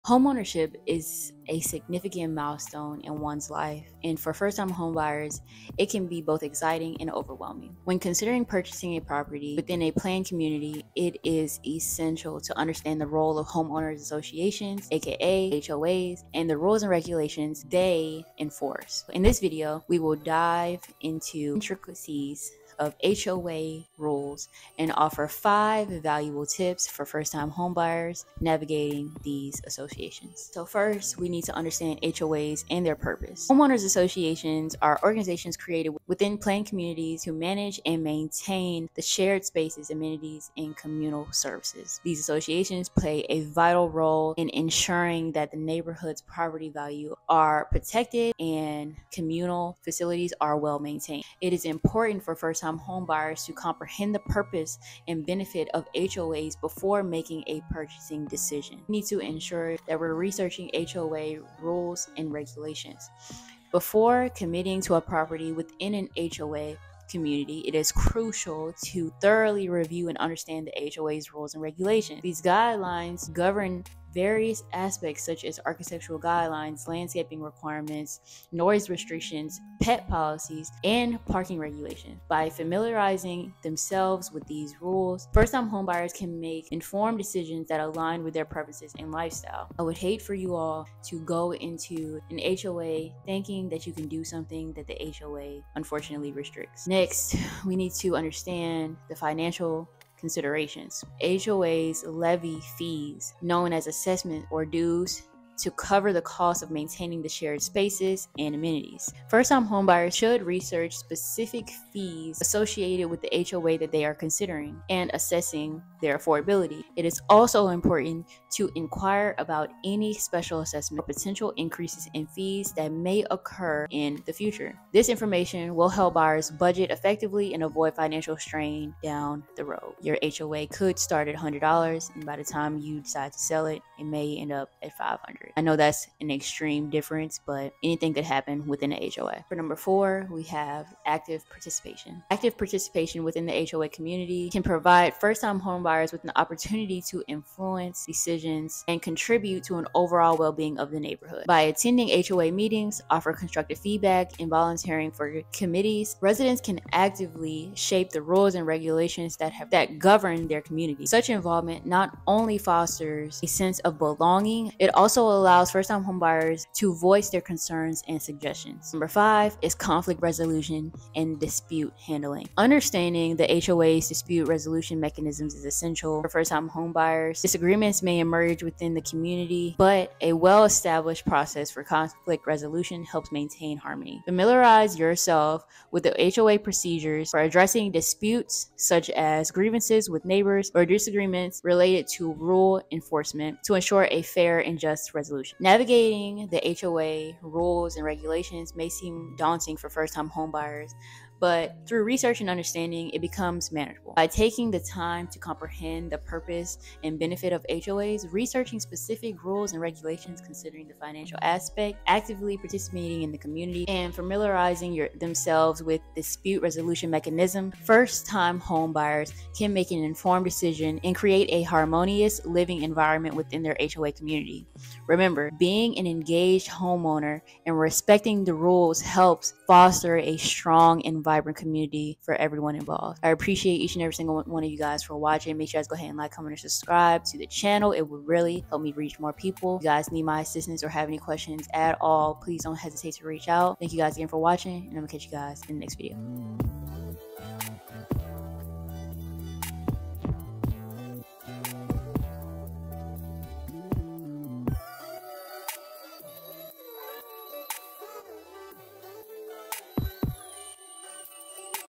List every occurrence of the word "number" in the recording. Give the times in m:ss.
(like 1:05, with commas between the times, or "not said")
2:19, 2:48.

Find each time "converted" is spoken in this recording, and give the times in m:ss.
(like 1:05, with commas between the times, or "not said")
not said.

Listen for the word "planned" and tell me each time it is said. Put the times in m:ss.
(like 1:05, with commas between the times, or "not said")
0:09, 0:36.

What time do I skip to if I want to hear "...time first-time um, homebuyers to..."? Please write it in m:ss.
0:52.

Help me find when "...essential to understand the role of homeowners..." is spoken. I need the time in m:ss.
0:11.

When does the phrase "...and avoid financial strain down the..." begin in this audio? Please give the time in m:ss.
2:07.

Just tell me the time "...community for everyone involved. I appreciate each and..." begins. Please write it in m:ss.
3:51.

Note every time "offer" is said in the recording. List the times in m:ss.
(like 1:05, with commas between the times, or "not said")
0:24, 2:33.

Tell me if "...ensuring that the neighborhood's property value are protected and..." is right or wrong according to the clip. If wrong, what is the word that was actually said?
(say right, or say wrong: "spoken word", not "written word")
right.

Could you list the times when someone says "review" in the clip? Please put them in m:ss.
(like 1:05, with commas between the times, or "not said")
1:09.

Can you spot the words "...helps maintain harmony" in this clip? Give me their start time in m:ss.
3:03.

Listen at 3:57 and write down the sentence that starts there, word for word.
It will really help me reach more people.